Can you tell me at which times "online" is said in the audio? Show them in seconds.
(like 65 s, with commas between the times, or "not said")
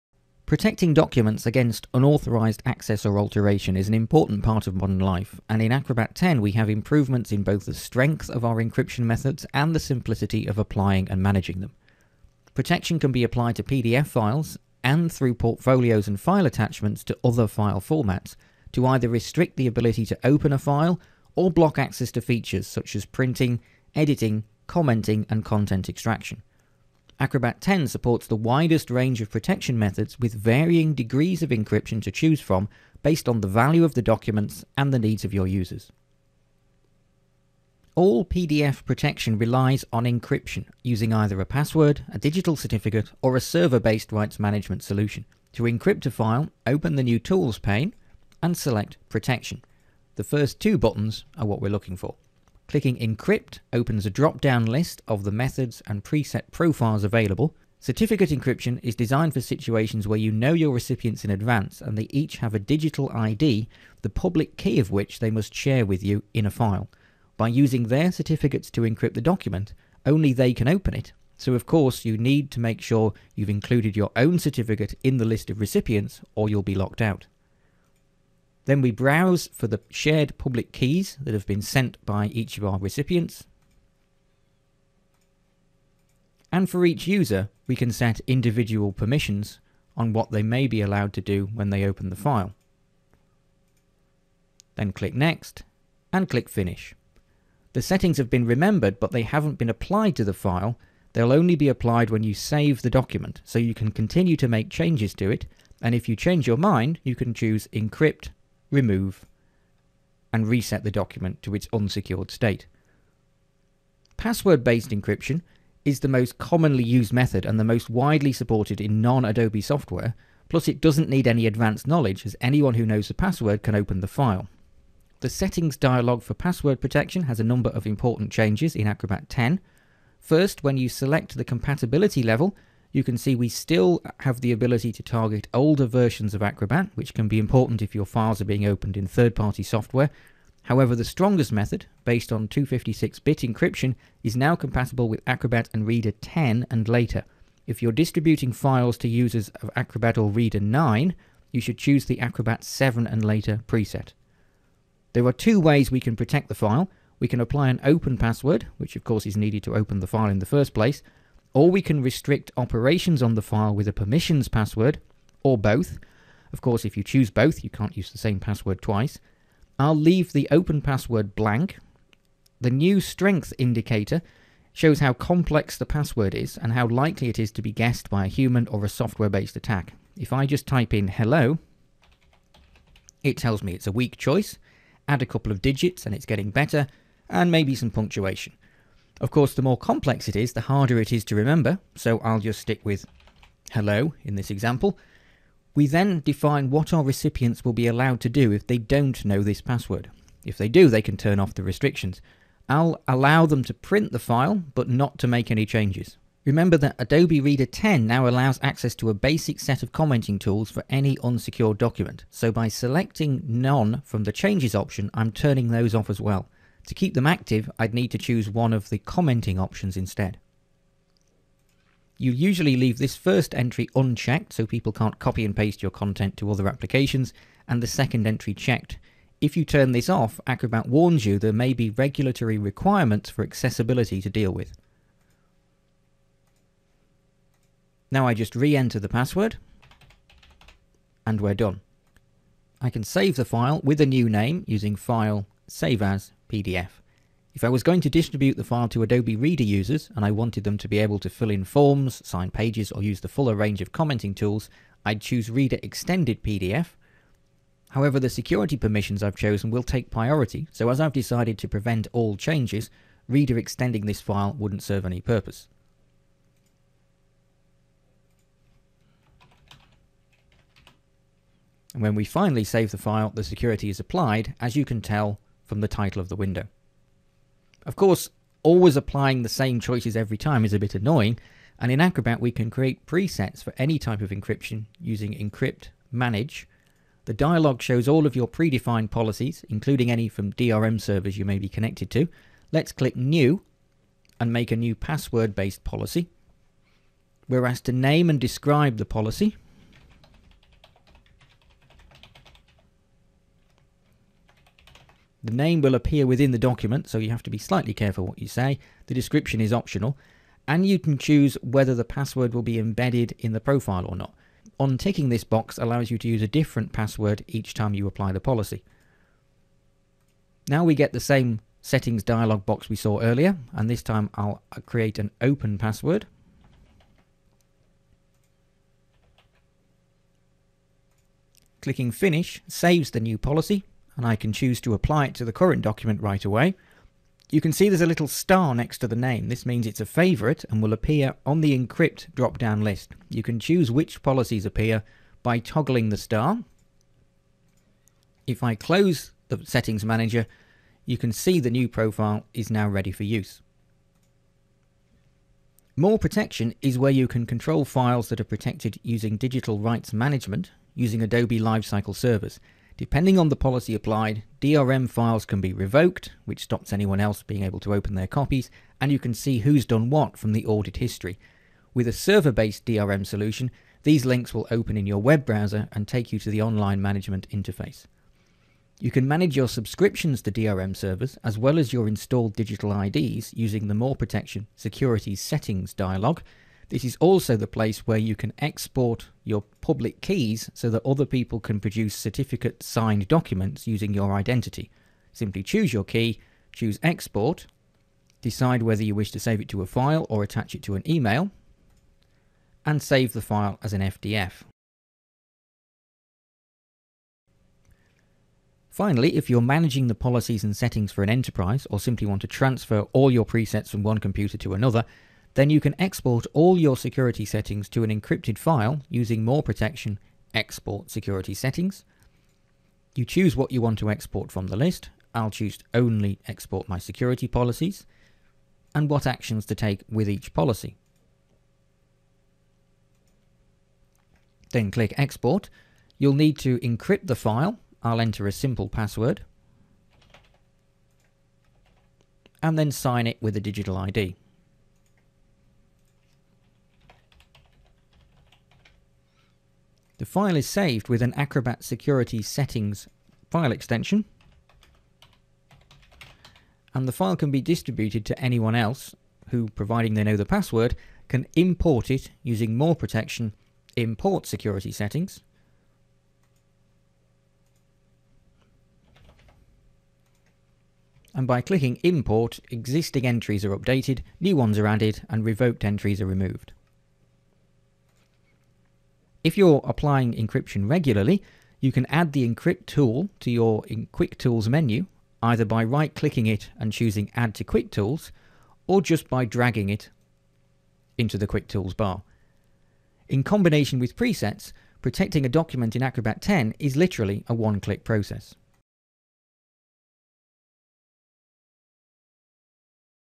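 376 s.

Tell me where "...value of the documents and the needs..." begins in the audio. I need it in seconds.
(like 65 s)
33 s.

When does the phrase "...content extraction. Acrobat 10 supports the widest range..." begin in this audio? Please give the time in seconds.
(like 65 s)
25 s.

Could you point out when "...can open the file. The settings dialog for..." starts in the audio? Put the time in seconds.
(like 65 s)
123 s.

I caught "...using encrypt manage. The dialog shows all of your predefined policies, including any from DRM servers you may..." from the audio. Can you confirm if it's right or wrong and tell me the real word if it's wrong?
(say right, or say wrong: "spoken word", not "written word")
right.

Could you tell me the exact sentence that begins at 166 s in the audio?
Of course, if you choose both, you can't use the same password twice.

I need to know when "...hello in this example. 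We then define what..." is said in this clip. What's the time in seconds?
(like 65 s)
193 s.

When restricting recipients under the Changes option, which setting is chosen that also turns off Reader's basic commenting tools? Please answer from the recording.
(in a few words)
None.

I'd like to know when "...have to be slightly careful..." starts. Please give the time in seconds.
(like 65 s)
307 s.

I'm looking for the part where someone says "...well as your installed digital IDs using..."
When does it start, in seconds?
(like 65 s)
381 s.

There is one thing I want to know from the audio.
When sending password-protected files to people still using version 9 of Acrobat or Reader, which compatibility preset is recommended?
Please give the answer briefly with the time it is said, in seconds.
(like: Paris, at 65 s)
Acrobat 7 and later, at 152 s.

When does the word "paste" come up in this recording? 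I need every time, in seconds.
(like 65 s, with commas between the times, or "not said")
225 s.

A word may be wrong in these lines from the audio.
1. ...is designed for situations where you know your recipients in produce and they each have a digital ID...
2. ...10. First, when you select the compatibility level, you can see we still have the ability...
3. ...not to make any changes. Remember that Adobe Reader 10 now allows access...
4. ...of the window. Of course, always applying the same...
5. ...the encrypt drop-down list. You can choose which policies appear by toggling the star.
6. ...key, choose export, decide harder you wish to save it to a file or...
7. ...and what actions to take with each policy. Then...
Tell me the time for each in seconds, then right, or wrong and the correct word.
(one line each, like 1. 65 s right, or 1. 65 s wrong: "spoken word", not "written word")
1. 58 s wrong: "advance", not "produce"
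2. 129 s right
3. 204 s right
4. 276 s right
5. 341 s right
6. 396 s wrong: "whether", not "harder"
7. 428 s right.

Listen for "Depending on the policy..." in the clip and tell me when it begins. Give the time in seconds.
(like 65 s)
362 s.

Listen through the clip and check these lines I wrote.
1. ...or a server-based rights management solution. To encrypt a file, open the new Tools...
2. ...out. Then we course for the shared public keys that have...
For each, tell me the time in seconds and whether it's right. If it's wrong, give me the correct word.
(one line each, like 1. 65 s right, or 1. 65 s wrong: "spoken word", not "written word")
1. 43 s right
2. 77 s wrong: "browse", not "course".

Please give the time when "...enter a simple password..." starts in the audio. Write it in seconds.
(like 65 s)
438 s.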